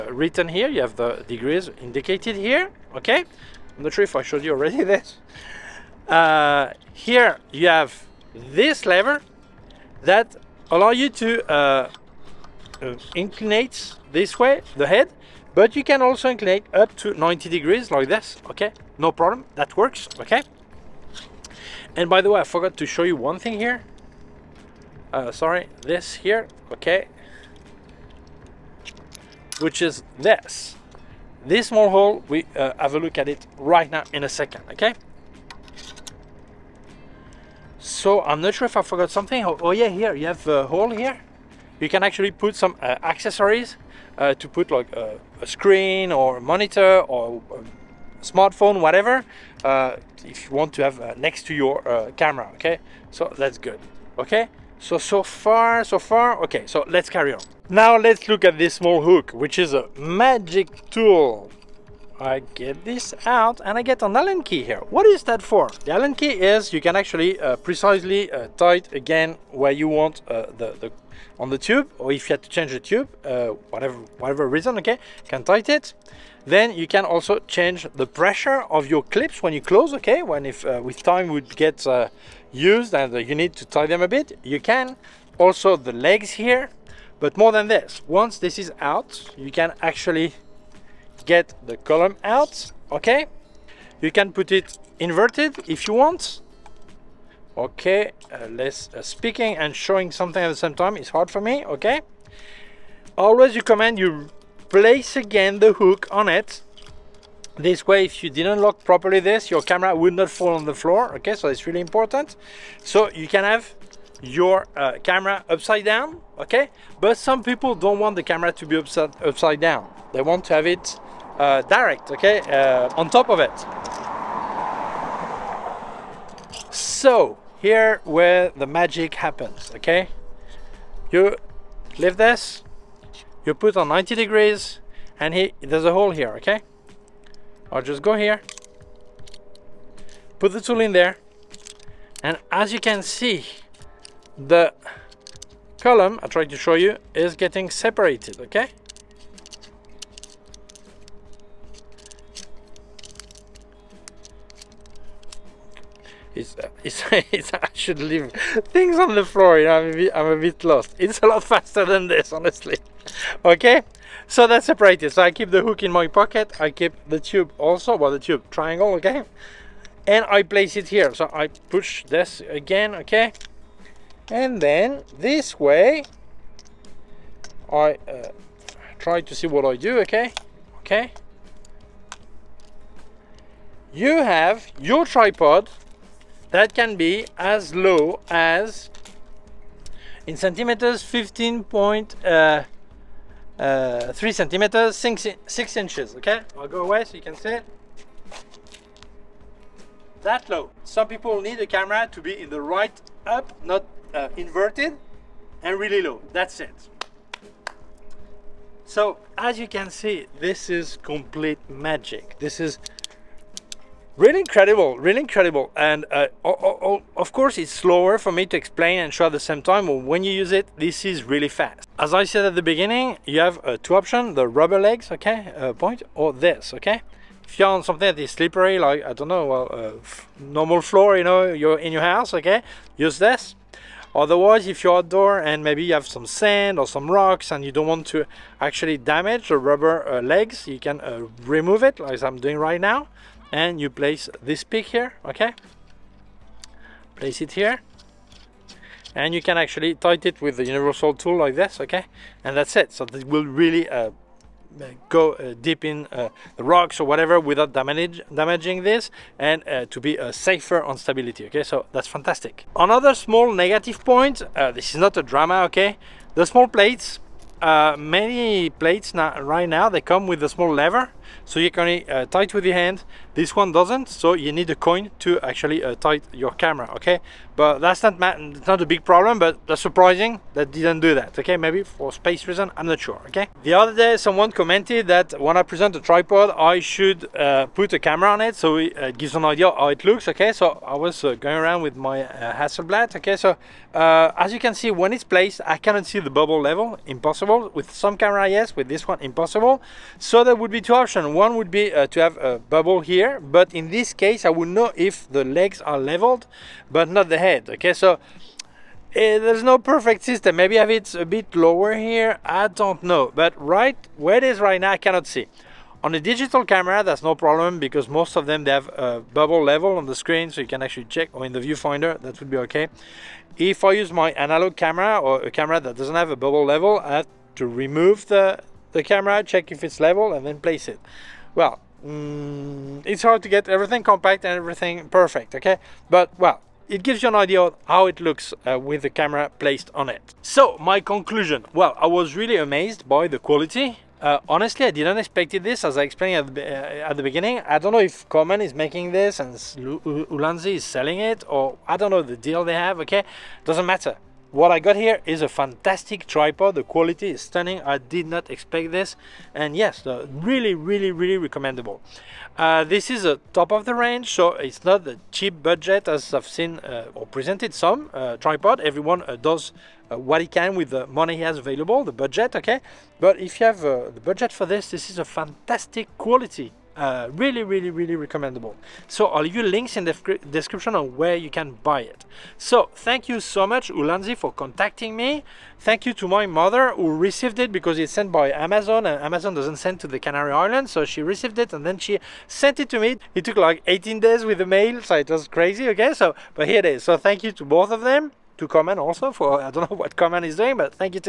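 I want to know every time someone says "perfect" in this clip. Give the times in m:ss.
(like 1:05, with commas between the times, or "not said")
5:09, 5:35.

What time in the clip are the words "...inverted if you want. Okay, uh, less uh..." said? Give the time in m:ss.
1:34.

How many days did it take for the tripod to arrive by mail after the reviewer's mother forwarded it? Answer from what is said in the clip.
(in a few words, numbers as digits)
18.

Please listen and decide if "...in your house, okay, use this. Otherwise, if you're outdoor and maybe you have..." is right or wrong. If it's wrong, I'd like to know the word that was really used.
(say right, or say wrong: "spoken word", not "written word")
right.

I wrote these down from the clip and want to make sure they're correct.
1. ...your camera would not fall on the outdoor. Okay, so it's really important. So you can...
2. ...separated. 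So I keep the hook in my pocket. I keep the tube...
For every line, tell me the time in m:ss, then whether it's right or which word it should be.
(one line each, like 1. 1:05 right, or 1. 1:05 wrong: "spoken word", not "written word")
1. 1:49 wrong: "floor", not "outdoor"
2. 2:44 right.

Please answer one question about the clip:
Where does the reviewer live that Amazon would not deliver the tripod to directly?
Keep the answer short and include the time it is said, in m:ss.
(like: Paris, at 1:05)
Canary Islands, at 6:30.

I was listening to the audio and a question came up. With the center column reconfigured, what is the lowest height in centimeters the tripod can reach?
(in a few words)
15.3.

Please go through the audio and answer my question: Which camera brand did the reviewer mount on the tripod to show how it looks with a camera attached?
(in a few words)
Hasselblad.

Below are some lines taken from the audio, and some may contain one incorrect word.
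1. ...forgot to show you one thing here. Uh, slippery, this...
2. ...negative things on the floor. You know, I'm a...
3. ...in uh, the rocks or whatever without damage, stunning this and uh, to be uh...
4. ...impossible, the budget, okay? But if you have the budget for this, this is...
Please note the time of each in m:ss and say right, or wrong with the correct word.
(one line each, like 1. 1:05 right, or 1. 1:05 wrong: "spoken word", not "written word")
1. 0:22 wrong: "sorry", not "slippery"
2. 2:37 wrong: "leave", not "negative"
3. 4:15 wrong: "damaging", not "stunning"
4. 6:11 wrong: "available", not "impossible".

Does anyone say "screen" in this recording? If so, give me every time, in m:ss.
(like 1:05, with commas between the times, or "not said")
0:45, 5:20.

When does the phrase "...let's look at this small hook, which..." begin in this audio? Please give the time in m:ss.
0:57.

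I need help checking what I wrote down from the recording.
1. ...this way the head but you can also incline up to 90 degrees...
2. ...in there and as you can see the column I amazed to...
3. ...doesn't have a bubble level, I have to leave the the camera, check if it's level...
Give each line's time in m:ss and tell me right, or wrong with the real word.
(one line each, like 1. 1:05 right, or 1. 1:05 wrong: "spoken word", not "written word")
1. 0:14 right
2. 2:20 wrong: "tried", not "amazed"
3. 5:25 wrong: "remove", not "leave".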